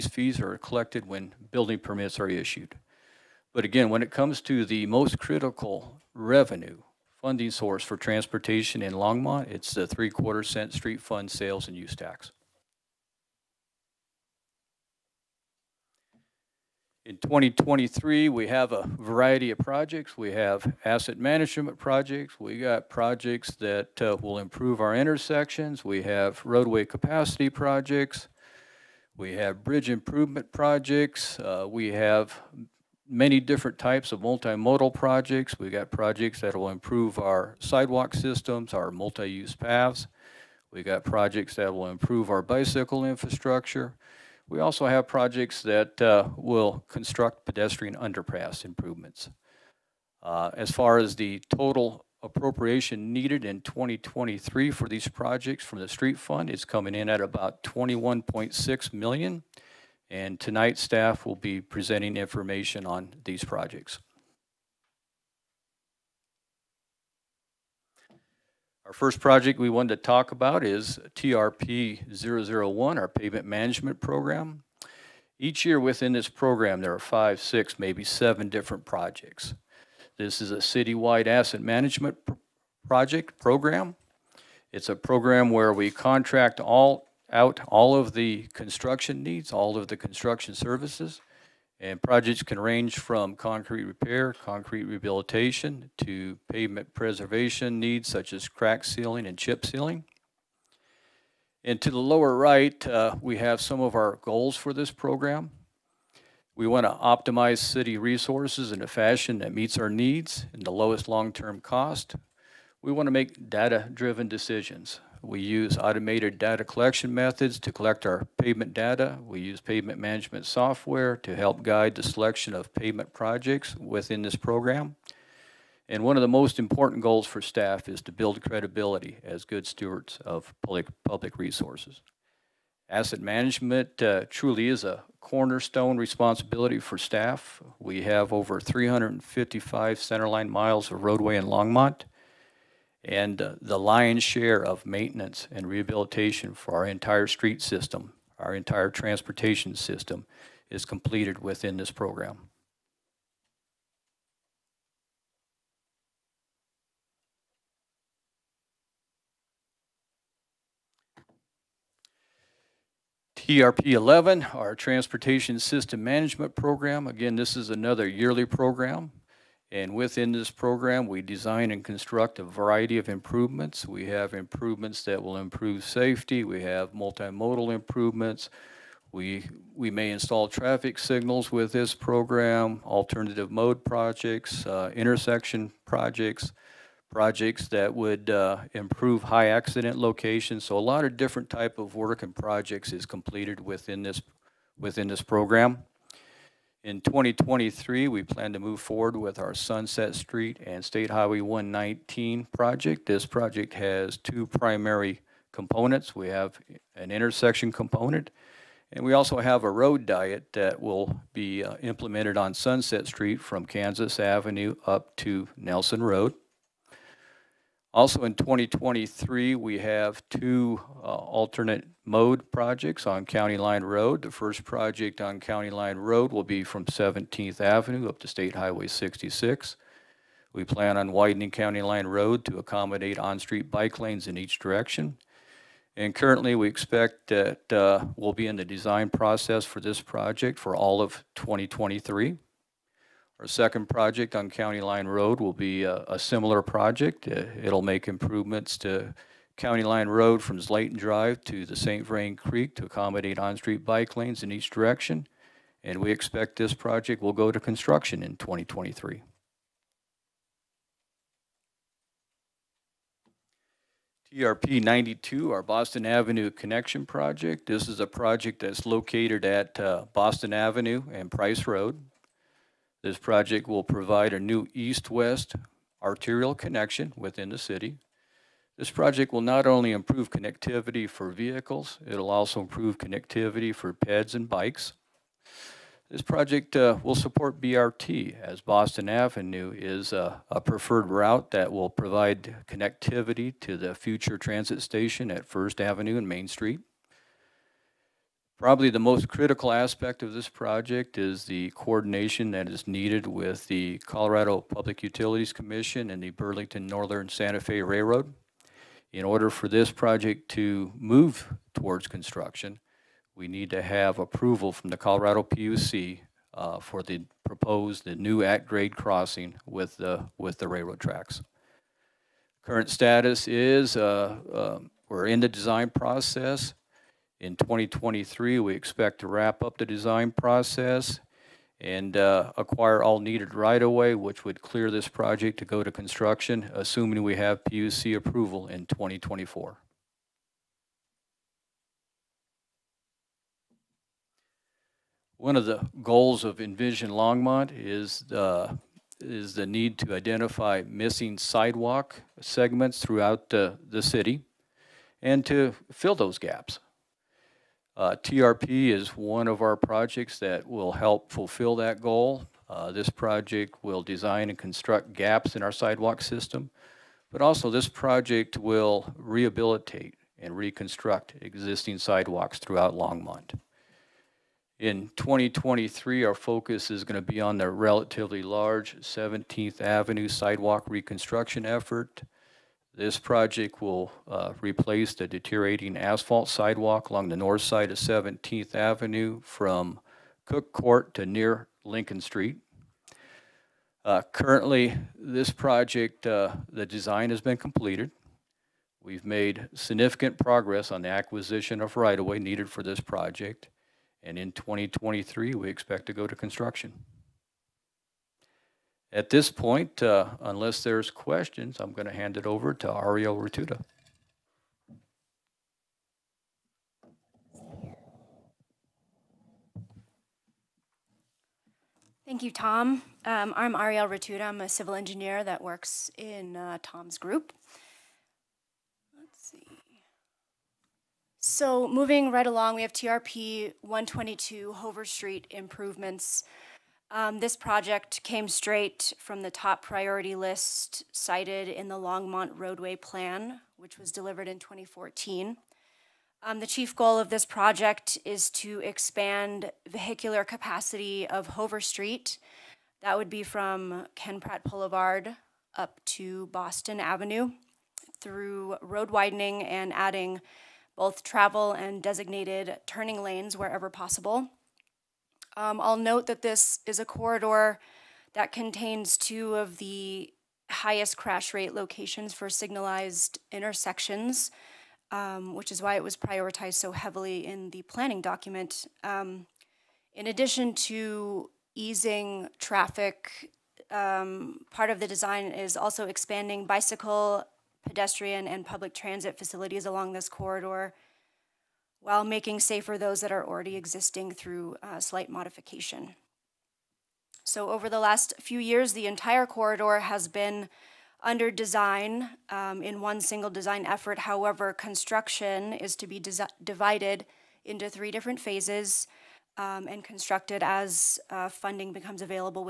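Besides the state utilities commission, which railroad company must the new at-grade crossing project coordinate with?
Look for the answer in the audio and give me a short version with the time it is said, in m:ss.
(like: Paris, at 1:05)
Burlington Northern Santa Fe, at 5:06.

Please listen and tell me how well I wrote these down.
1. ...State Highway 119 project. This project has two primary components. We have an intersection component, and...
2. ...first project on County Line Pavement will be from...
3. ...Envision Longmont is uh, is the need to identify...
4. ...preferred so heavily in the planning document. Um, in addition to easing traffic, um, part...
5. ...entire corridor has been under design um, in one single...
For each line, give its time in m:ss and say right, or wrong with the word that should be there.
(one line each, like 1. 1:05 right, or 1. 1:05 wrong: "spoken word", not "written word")
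1. 3:20 right
2. 3:44 wrong: "Road", not "Pavement"
3. 5:46 right
4. 7:56 wrong: "prioritized", not "preferred"
5. 8:19 right.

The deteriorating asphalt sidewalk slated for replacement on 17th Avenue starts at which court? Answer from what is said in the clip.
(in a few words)
Cook Court.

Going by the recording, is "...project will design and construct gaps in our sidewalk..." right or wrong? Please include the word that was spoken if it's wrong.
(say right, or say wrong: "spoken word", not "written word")
right.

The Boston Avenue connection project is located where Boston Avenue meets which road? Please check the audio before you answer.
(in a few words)
Price Road.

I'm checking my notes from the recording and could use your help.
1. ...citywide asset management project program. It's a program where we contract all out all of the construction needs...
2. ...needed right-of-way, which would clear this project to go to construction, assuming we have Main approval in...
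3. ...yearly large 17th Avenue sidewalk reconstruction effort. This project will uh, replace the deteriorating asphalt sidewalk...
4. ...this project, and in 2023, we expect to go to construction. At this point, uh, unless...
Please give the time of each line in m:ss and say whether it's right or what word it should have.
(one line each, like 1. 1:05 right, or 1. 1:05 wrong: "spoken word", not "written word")
1. 1:20 right
2. 5:33 wrong: "PUC", not "Main"
3. 6:17 wrong: "relatively", not "yearly"
4. 6:42 right.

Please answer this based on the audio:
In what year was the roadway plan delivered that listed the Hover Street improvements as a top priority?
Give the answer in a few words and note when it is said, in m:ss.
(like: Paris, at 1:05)
2014, at 7:24.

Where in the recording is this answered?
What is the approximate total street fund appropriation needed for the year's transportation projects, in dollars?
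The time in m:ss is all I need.
0:57.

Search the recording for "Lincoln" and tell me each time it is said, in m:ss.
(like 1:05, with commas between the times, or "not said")
6:31.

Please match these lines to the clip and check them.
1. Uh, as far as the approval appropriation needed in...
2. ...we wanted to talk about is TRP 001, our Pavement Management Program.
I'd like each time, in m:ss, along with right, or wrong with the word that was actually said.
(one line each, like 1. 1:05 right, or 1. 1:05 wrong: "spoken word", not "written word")
1. 0:50 wrong: "total", not "approval"
2. 1:09 right.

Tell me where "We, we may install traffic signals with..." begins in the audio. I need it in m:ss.
2:59.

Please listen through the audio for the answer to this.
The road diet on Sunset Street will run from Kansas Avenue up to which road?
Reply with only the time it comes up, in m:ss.
3:35.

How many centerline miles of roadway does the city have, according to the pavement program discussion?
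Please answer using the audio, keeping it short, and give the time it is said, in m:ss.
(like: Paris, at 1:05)
355, at 2:18.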